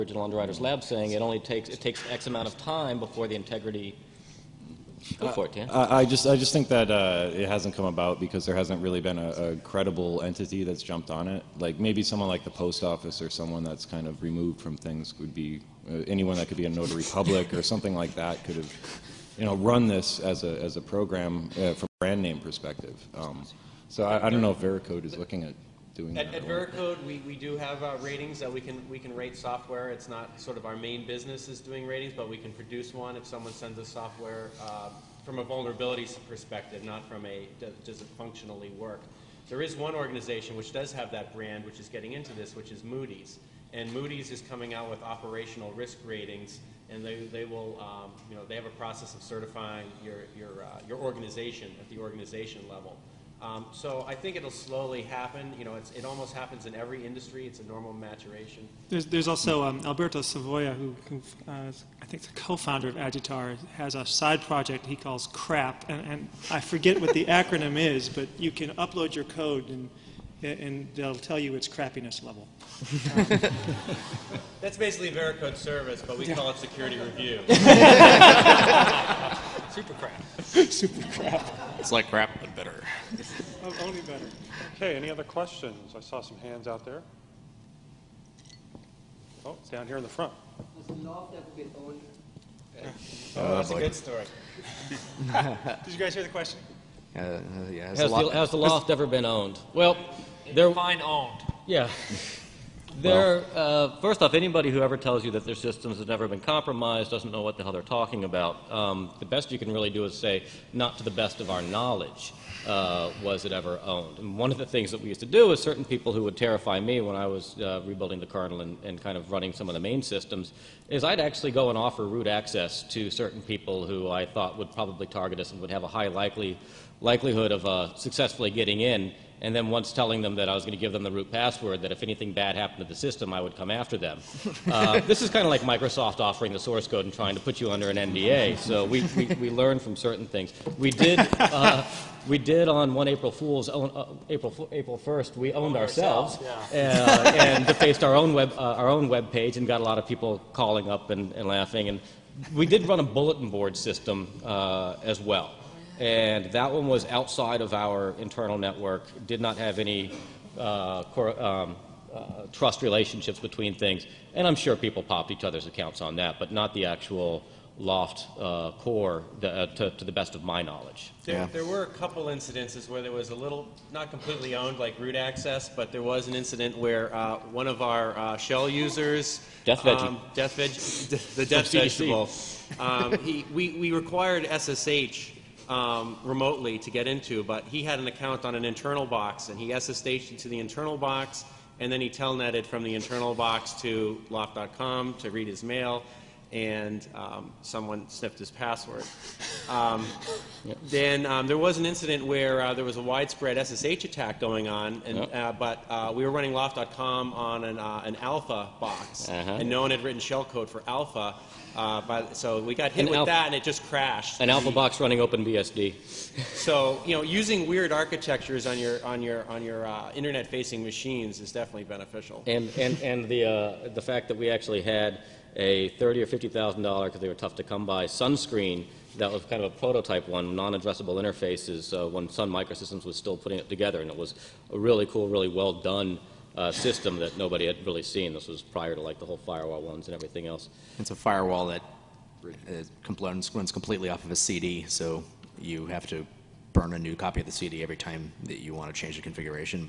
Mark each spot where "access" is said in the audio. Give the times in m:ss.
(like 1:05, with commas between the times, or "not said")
2:02, 2:55.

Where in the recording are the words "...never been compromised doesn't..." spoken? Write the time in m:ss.
1:46.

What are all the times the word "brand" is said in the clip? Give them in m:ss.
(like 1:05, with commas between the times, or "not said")
0:22, 0:41.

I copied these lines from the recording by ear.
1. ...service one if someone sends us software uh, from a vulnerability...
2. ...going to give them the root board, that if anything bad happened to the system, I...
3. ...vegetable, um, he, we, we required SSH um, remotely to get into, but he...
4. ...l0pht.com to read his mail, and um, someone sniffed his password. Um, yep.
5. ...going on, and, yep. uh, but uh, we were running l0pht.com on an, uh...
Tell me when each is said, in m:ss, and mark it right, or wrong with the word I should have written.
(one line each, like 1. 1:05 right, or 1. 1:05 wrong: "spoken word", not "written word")
1. 0:32 wrong: "produce", not "service"
2. 2:10 wrong: "password", not "board"
3. 3:01 right
4. 3:14 right
5. 3:24 right.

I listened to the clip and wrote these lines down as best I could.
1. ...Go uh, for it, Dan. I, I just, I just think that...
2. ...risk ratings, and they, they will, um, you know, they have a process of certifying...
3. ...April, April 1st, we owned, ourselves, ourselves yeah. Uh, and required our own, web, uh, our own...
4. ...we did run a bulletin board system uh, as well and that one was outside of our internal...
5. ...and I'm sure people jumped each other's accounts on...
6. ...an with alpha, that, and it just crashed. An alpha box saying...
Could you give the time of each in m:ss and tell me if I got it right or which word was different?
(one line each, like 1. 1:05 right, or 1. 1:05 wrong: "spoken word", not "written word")
1. 0:05 right
2. 0:45 right
3. 2:24 wrong: "defaced", not "required"
4. 2:32 right
5. 2:44 wrong: "popped", not "jumped"
6. 3:33 wrong: "running", not "saying".